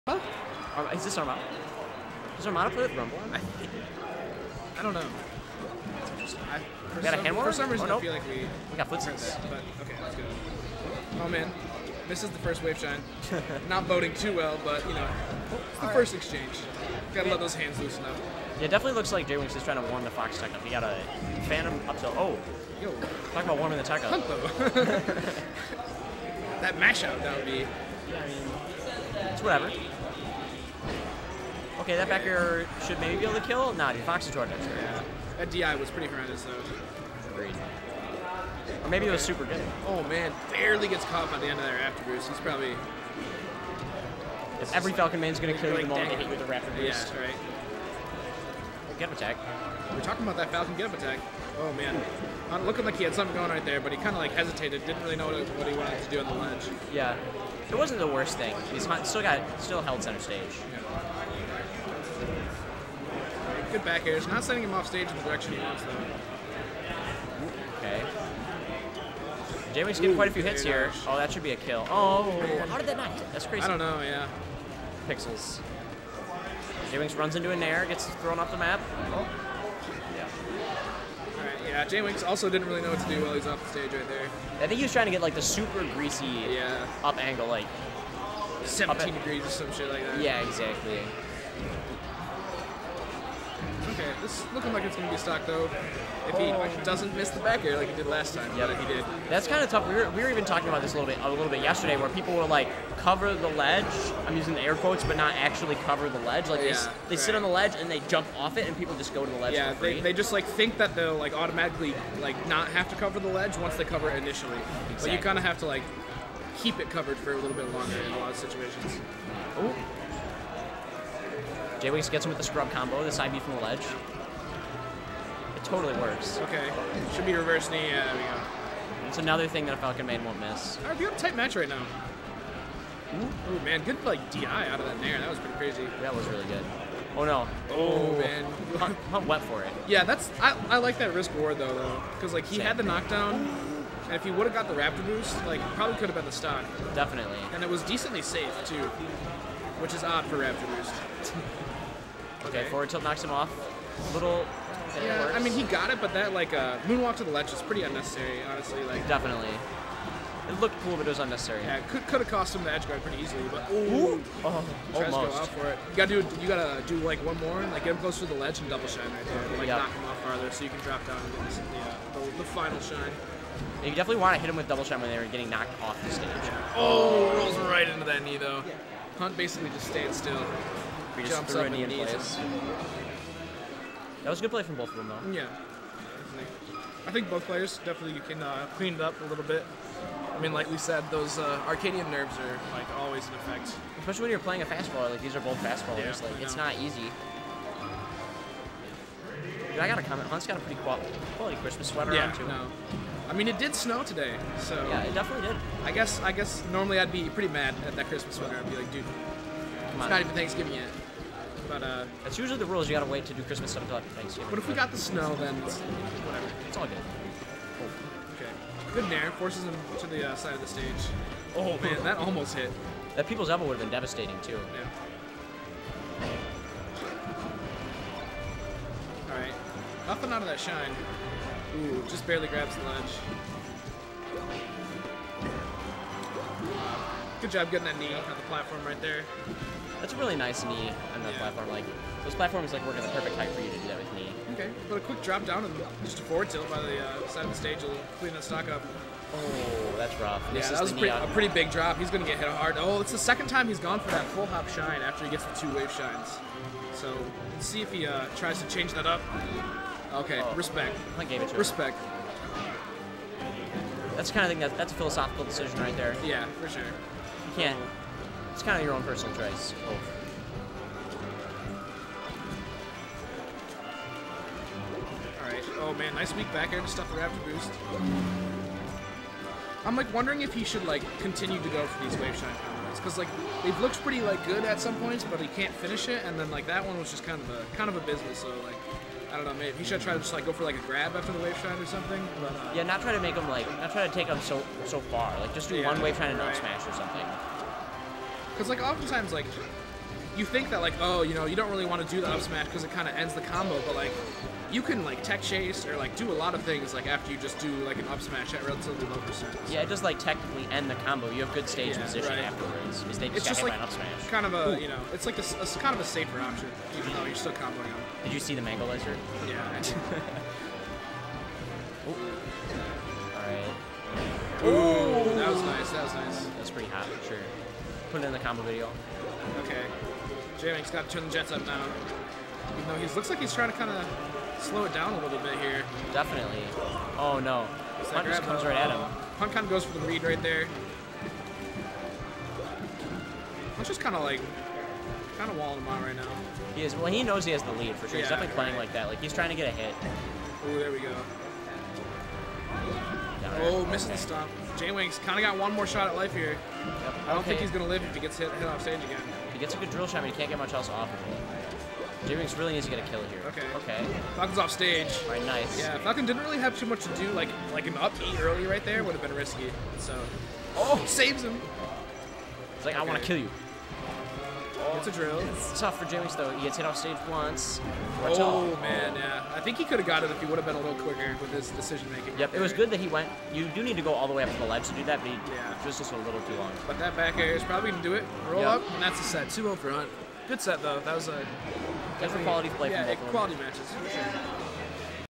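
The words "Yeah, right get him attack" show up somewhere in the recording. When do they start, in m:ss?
0:47.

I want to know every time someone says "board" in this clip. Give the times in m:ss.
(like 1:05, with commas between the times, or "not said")
2:21.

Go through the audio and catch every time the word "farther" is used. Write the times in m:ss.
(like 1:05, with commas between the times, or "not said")
2:50.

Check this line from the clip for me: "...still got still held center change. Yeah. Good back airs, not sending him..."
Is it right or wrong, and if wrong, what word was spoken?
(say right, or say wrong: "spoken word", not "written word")
wrong: "stage", not "change".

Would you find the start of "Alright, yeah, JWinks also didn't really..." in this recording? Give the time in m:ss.
1:21.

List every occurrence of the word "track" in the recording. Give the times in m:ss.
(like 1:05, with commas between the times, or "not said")
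not said.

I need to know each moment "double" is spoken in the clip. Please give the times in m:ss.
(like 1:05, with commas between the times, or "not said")
2:48, 2:54.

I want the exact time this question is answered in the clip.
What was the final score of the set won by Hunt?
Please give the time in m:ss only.
6:29.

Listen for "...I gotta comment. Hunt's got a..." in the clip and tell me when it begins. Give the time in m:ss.
3:19.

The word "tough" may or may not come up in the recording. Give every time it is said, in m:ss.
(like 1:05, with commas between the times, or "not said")
1:39, 6:15.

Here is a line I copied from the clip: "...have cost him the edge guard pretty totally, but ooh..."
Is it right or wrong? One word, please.
wrong.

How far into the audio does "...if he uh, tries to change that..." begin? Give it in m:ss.
4:17.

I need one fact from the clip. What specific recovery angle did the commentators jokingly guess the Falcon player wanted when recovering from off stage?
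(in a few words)
17 degrees.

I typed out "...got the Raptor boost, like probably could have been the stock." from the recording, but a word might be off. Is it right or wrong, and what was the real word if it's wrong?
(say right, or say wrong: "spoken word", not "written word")
right.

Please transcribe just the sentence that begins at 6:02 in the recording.
j really needs to get a kill here.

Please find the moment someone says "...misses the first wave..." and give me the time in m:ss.
0:12.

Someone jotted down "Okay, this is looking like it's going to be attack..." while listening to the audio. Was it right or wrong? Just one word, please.
wrong.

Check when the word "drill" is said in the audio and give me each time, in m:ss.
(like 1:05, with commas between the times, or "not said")
5:59, 6:15.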